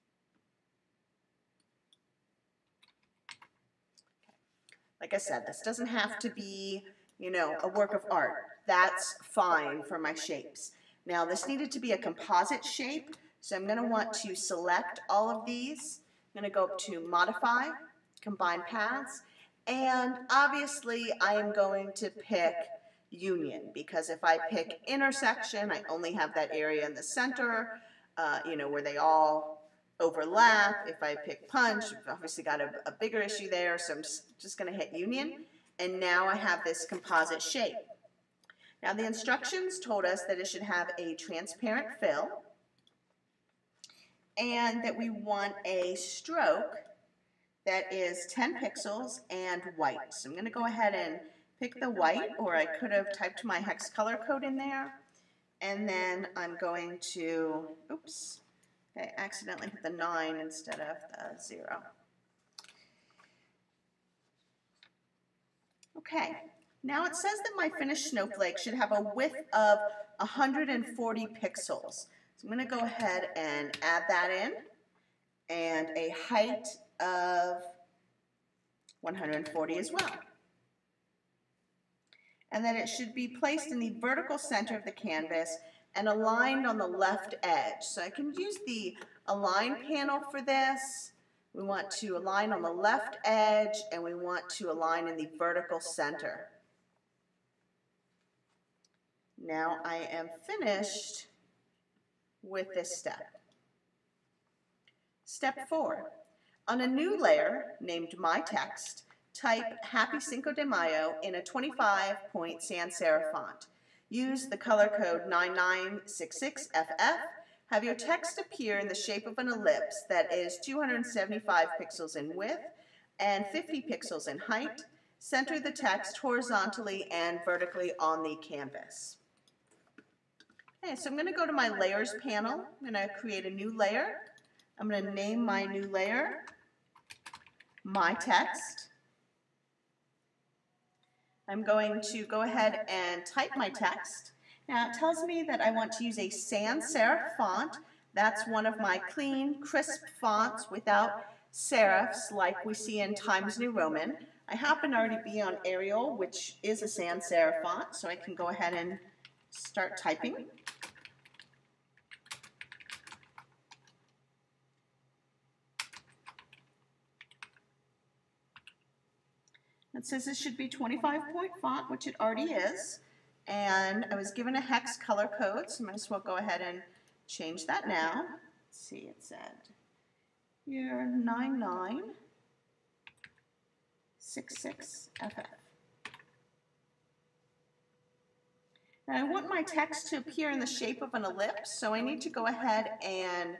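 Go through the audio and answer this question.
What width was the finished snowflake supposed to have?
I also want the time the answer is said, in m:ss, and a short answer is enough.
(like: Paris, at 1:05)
140 pixels, at 1:10.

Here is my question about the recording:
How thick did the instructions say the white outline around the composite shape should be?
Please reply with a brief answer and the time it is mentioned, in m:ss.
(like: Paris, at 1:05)
10 pixels, at 0:48.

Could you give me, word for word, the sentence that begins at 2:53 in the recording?
And I was given a hex color code, so I might as well go ahead and change that now.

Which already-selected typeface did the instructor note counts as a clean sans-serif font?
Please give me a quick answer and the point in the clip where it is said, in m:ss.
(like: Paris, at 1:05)
Arial, at 2:35.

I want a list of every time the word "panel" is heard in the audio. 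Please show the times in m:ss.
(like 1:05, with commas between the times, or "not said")
1:29, 2:12.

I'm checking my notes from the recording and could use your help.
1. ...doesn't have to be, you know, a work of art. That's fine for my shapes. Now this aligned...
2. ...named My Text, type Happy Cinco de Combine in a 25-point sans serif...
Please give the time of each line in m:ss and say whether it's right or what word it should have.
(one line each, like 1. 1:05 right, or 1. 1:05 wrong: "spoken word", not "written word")
1. 0:05 wrong: "needed", not "aligned"
2. 1:47 wrong: "Mayo", not "Combine".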